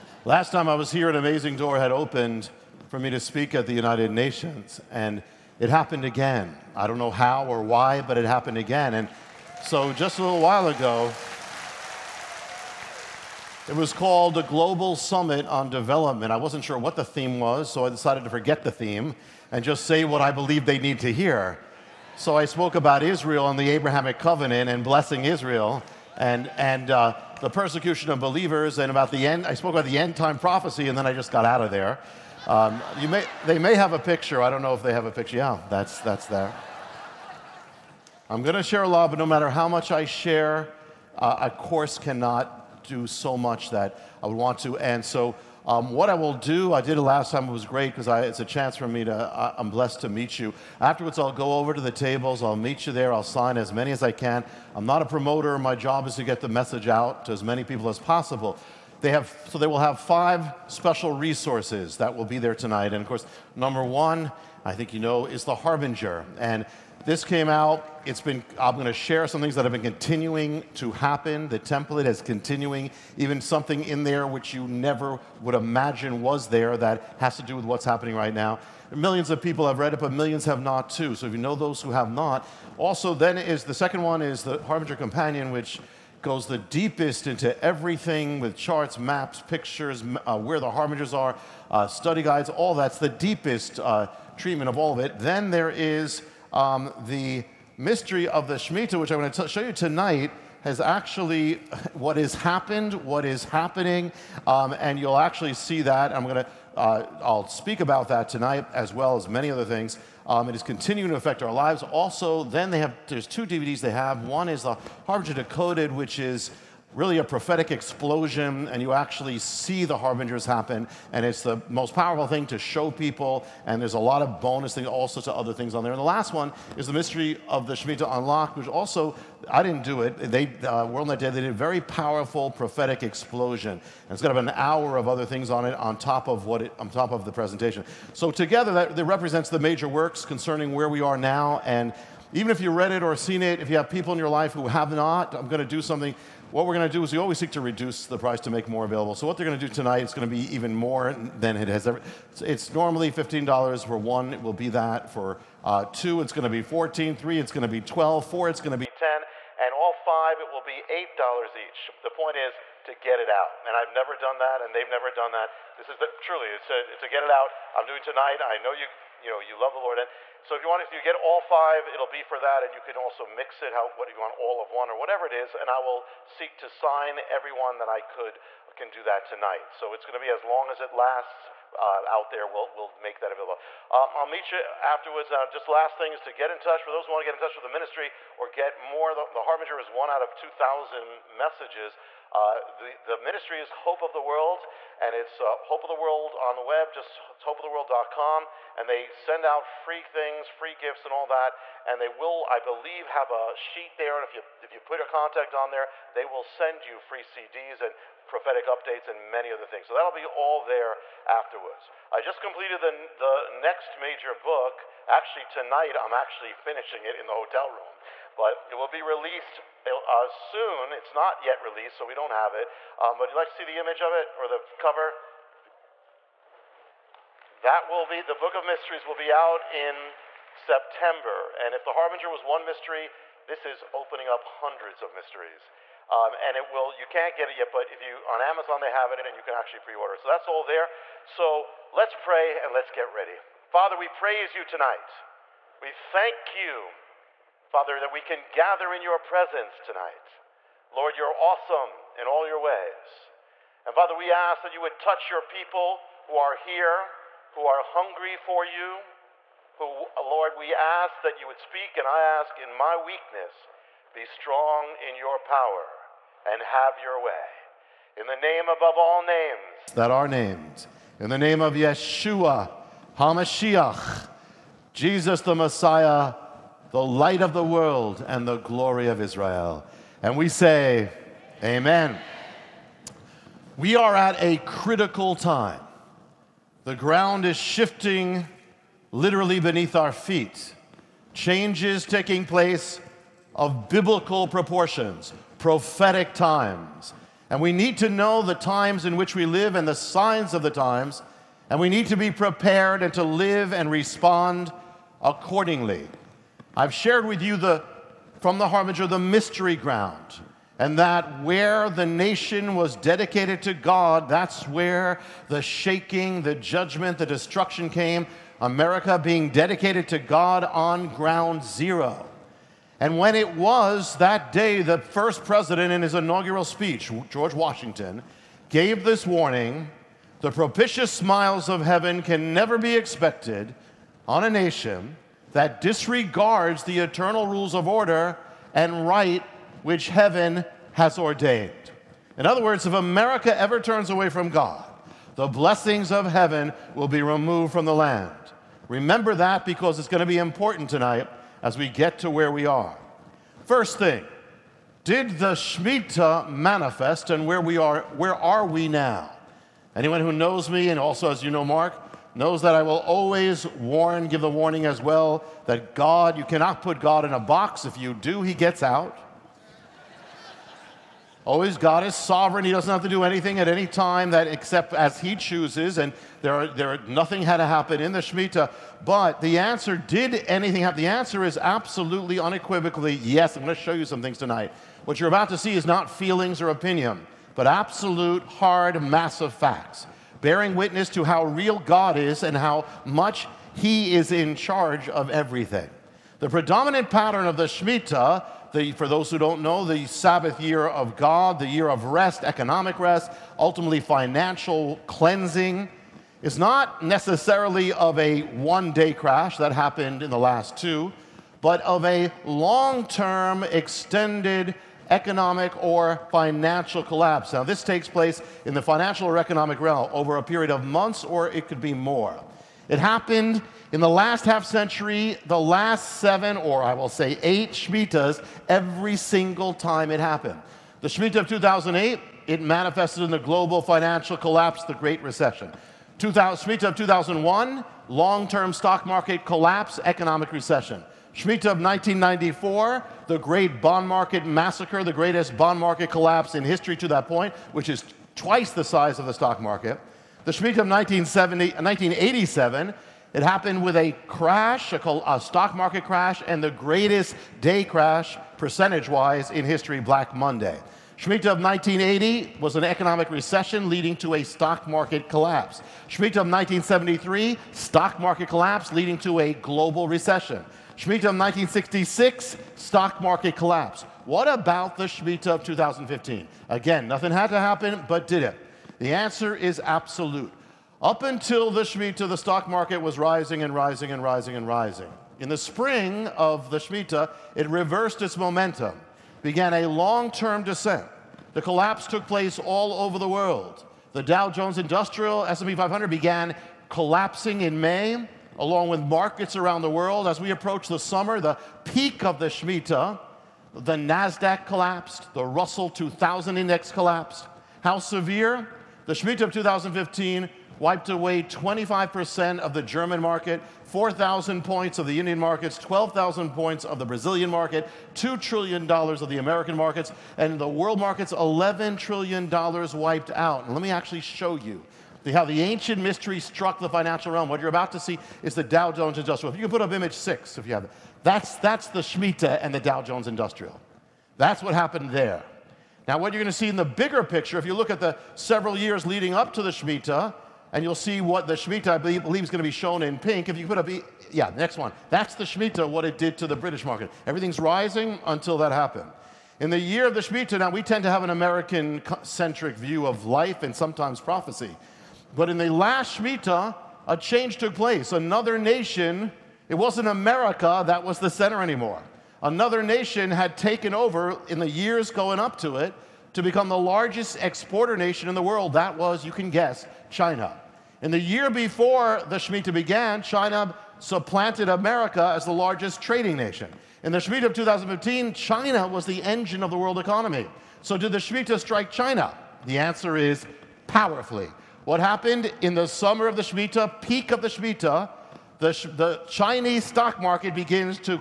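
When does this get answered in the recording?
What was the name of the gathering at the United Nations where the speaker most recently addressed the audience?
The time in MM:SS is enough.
00:14.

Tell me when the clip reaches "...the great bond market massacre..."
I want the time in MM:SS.
07:23.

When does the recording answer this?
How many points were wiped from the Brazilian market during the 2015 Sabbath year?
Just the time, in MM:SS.
08:35.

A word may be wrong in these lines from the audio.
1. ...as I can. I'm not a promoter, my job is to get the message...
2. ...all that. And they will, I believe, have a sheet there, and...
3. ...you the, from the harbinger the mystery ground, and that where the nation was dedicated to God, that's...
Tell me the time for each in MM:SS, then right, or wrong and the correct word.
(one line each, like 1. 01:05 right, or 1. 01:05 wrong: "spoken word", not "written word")
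1. 00:53 right
2. 03:21 right
3. 05:07 right.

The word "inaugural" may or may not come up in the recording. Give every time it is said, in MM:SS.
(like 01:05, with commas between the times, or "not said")
05:26.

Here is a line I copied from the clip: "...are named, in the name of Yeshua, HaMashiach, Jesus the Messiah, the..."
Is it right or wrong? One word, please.
right.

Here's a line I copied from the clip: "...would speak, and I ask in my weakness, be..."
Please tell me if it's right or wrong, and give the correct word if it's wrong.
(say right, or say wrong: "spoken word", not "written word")
right.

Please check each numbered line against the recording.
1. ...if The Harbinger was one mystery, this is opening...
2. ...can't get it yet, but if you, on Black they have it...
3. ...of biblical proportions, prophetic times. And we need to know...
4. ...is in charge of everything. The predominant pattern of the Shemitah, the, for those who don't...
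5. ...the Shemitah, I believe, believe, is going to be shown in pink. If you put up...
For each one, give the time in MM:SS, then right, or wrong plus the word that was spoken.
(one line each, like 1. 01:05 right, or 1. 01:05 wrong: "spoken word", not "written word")
1. 03:51 right
2. 03:57 wrong: "Amazon", not "Black"
3. 04:53 right
4. 06:34 right
5. 09:01 right.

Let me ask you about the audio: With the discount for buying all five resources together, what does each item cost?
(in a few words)
$8.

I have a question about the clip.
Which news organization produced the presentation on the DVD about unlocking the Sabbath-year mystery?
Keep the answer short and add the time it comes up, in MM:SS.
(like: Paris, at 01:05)
WorldNetDaily, at 02:10.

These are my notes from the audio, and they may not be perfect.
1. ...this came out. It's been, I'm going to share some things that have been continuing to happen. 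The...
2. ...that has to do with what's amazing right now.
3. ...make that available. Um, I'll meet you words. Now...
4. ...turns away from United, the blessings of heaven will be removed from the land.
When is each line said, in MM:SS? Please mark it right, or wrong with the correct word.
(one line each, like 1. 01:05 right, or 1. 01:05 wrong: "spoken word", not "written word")
1. 01:07 right
2. 01:16 wrong: "happening", not "amazing"
3. 03:02 wrong: "afterwards", not "words"
4. 05:43 wrong: "God", not "United".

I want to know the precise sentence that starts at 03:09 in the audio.
The, the Harbinger is one out of two thousand messages.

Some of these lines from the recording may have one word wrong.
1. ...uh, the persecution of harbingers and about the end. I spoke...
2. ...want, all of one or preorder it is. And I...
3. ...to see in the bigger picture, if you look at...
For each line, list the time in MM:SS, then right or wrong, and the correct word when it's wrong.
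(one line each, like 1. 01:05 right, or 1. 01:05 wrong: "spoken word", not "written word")
1. 00:26 wrong: "believers", not "harbingers"
2. 02:54 wrong: "whatever", not "preorder"
3. 08:56 right.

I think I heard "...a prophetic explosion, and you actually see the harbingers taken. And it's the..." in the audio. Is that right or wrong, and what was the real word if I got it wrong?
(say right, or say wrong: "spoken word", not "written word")
wrong: "happen", not "taken".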